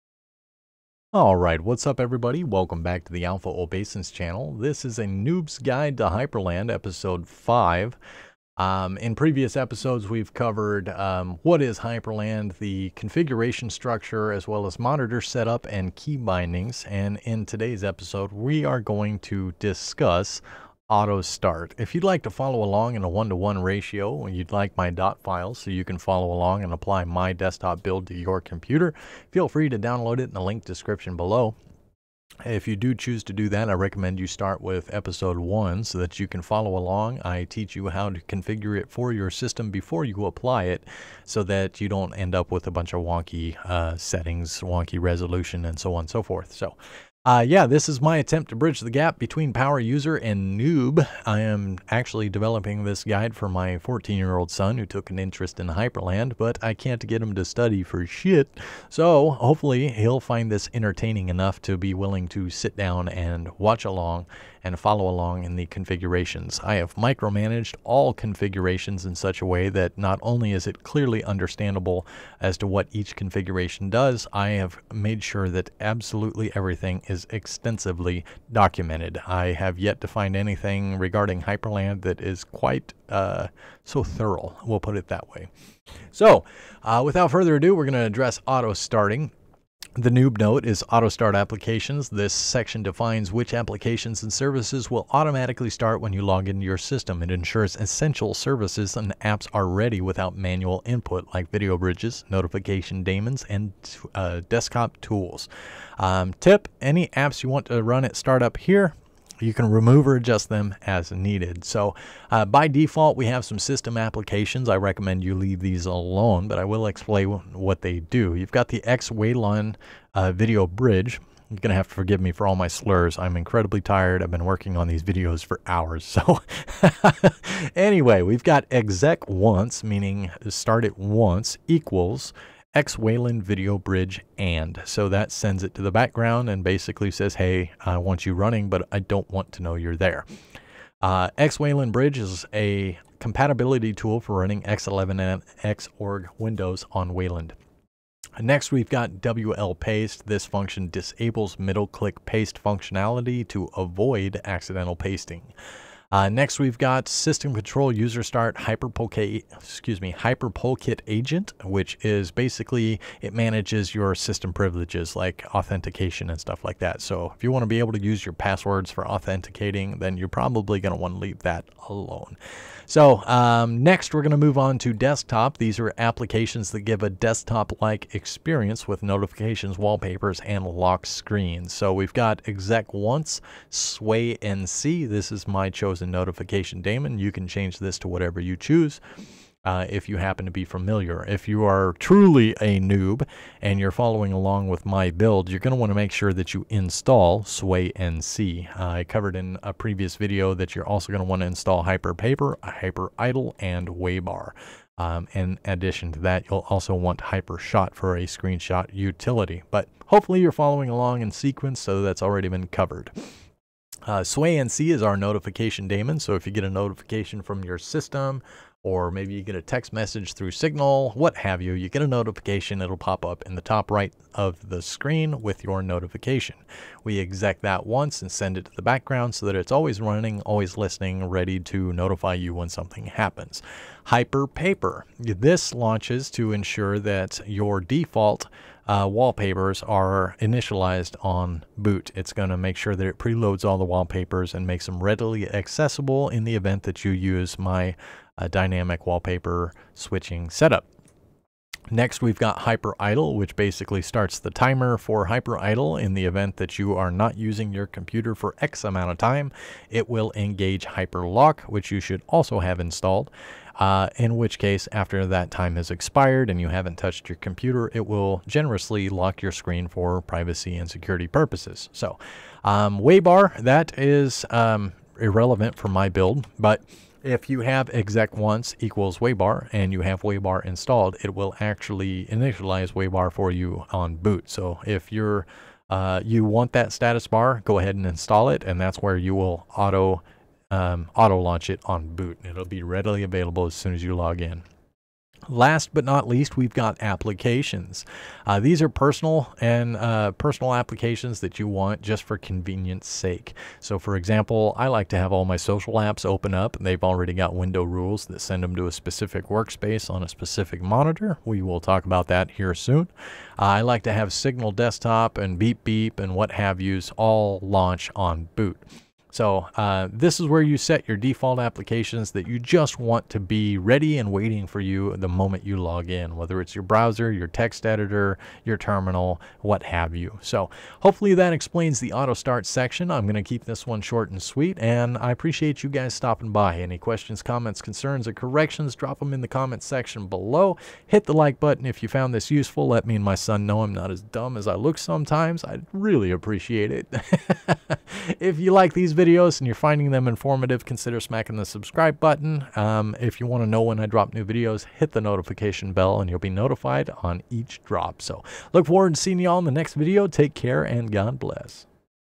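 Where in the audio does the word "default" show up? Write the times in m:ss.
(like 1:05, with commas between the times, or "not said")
1:52, 3:57, 5:21.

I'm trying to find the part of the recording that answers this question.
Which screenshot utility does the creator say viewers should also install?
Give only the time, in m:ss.
3:27.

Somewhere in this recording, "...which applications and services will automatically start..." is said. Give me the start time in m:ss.
1:33.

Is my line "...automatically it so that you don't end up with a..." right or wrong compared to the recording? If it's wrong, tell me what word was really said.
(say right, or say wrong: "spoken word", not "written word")
wrong: "apply", not "automatically".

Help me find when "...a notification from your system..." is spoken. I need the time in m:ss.
3:36.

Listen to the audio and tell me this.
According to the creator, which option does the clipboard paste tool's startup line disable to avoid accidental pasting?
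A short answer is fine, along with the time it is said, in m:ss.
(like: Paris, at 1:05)
middle click paste, at 2:31.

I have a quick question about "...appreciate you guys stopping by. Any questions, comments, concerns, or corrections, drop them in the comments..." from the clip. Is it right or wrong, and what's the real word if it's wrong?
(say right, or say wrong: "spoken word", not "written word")
right.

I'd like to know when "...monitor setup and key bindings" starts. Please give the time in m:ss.
0:14.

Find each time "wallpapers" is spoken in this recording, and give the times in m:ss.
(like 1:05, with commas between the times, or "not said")
2:59, 3:59, 4:03, 4:09.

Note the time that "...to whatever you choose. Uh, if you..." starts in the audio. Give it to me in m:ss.
3:07.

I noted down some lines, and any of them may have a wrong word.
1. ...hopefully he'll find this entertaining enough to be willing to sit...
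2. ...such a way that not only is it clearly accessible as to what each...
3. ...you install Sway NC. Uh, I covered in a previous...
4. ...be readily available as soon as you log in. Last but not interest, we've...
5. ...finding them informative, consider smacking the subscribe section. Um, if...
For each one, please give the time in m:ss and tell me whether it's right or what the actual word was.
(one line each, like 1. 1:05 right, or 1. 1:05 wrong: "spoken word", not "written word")
1. 0:59 right
2. 1:09 wrong: "understandable", not "accessible"
3. 3:16 right
4. 4:52 wrong: "least", not "interest"
5. 5:49 wrong: "button", not "section".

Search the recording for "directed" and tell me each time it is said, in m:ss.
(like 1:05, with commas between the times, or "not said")
not said.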